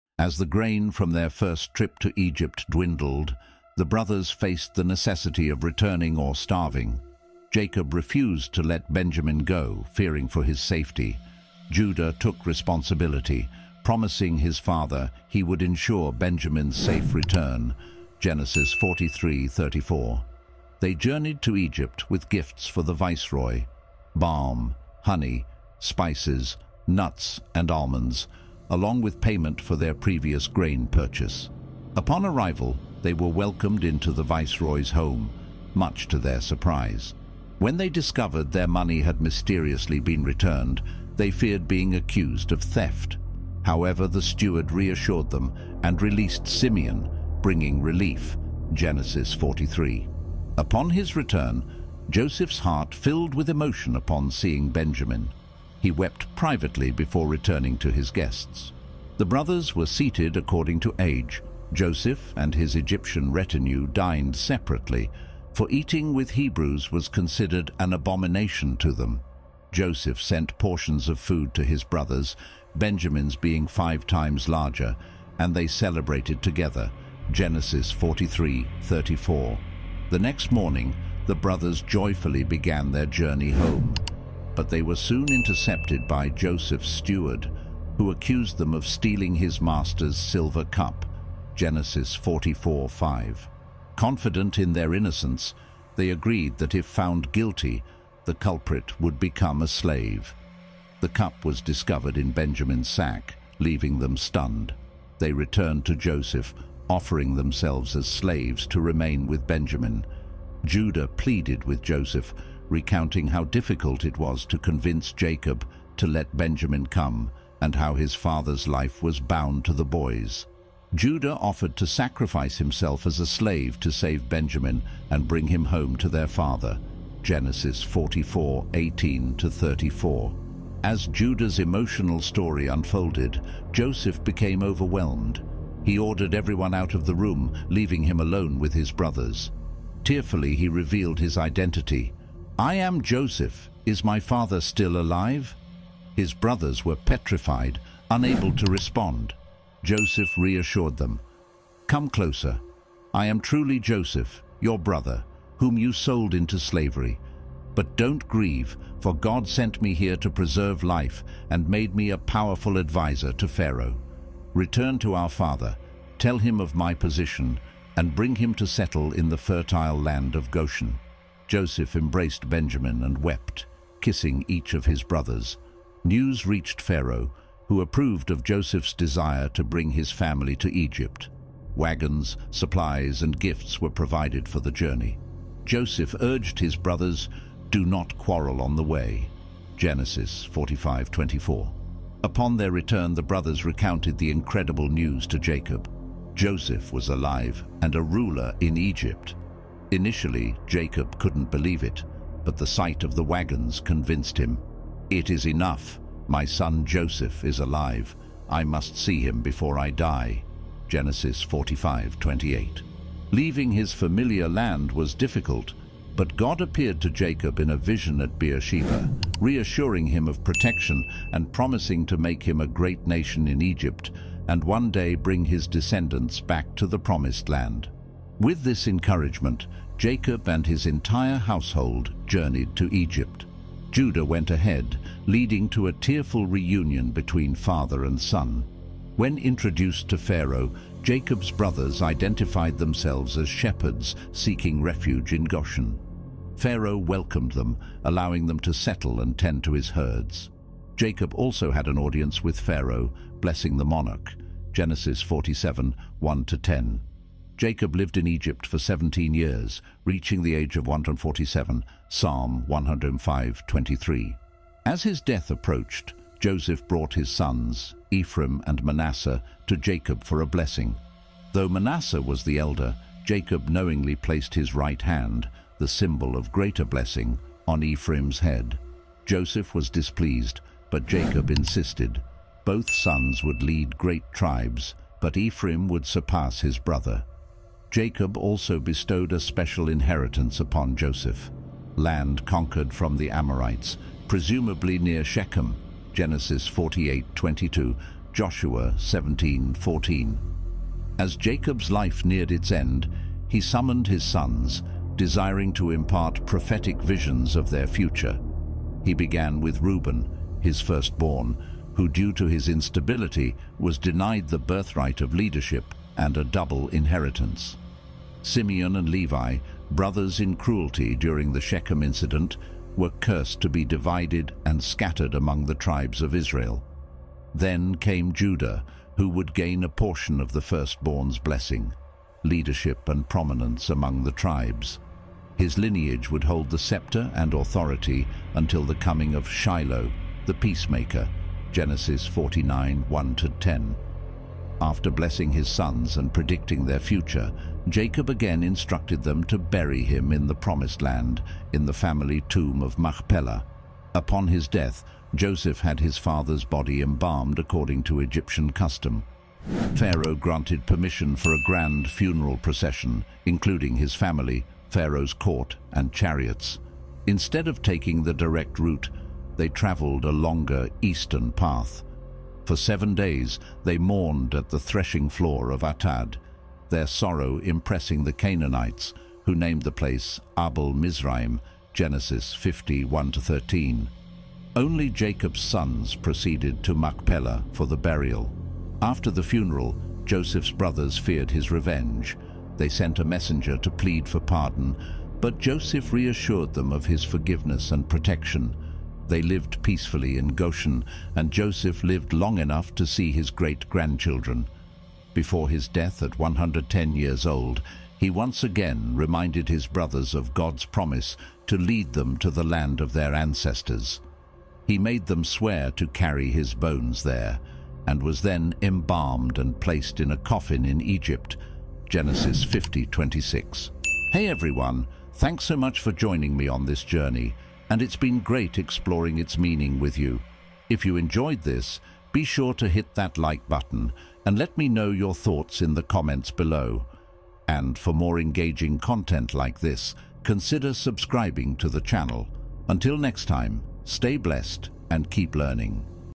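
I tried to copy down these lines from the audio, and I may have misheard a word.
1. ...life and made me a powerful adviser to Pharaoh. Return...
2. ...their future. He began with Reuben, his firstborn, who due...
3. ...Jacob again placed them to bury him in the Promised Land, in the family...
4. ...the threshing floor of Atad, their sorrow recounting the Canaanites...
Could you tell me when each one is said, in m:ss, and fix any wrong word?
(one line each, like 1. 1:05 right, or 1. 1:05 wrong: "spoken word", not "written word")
1. 2:40 right
2. 5:07 right
3. 5:47 wrong: "instructed", not "placed"
4. 6:14 wrong: "impressing", not "recounting".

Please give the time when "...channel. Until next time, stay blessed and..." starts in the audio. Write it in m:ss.
7:22.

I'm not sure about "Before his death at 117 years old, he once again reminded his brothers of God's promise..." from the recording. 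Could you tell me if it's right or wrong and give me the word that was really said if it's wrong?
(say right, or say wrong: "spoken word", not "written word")
wrong: "110", not "117".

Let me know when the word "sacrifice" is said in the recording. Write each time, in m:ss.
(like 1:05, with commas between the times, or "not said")
2:01.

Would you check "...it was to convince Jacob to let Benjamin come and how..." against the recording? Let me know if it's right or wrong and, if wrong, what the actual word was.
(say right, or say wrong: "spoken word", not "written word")
right.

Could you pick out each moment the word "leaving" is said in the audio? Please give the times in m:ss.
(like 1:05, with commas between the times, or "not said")
1:43, 2:17, 3:33.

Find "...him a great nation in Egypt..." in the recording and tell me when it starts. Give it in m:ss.
3:42.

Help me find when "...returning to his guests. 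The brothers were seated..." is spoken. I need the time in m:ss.
0:57.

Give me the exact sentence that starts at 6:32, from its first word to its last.
They sent a messenger to plead for pardon, but Joseph reassured them of his forgiveness and protection.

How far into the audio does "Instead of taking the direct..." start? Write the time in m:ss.
6:07.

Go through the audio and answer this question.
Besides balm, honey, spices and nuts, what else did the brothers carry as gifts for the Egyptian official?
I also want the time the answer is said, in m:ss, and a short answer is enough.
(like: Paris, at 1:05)
almonds, at 0:27.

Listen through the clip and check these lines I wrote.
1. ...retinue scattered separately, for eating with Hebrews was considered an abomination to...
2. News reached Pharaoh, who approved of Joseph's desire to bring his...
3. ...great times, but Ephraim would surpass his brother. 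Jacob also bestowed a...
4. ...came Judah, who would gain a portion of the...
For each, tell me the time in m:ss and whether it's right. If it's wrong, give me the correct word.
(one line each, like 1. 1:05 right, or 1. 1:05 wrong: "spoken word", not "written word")
1. 1:03 wrong: "dined", not "scattered"
2. 2:56 right
3. 4:43 wrong: "tribes", not "times"
4. 5:27 right.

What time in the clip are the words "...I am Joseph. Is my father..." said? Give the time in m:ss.
2:22.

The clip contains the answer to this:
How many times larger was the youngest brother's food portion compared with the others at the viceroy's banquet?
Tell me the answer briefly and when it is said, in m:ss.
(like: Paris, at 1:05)
5, at 1:13.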